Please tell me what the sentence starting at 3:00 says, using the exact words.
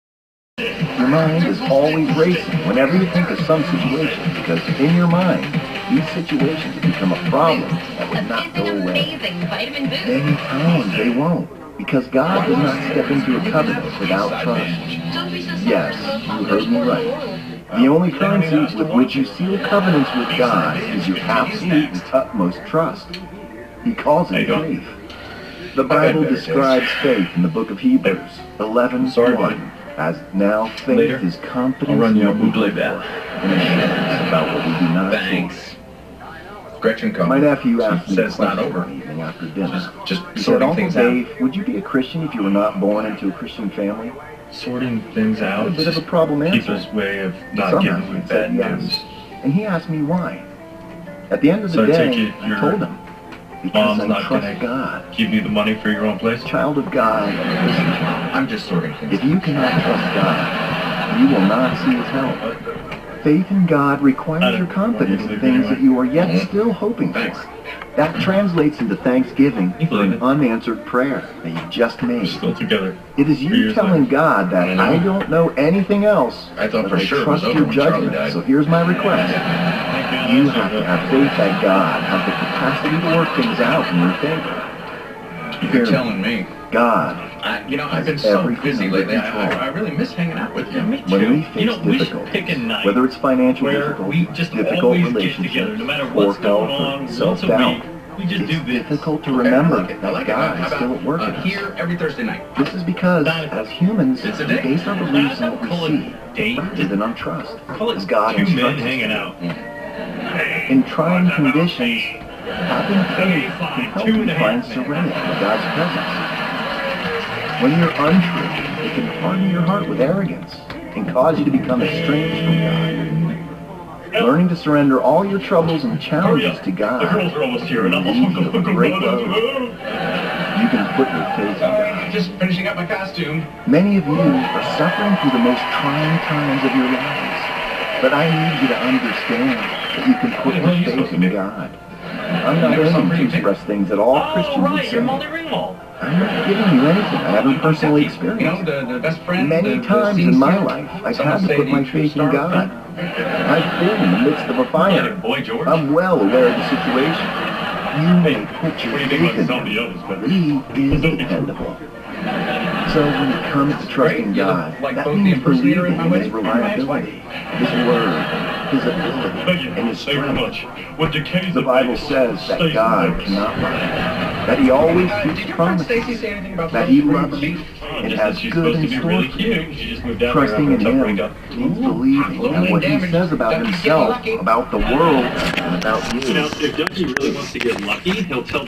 Trusting in Him means believing in what He says about Himself, about the world, and about you.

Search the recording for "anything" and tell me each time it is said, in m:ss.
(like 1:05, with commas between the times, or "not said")
1:15, 2:26.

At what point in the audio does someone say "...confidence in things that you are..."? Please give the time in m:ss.
1:04.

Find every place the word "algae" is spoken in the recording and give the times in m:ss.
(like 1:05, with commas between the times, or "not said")
not said.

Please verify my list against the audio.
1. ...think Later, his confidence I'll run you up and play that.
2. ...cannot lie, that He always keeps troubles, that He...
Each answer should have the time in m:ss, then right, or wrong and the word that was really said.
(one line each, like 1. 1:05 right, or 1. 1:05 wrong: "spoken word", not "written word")
1. 0:30 right
2. 2:53 wrong: "promises", not "troubles".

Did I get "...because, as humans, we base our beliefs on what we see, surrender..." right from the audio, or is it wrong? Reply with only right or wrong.
wrong.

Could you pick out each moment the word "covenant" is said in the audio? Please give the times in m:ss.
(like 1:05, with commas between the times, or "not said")
0:13, 0:19.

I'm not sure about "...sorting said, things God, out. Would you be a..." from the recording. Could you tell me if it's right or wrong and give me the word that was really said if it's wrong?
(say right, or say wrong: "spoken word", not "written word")
wrong: "Dave", not "God".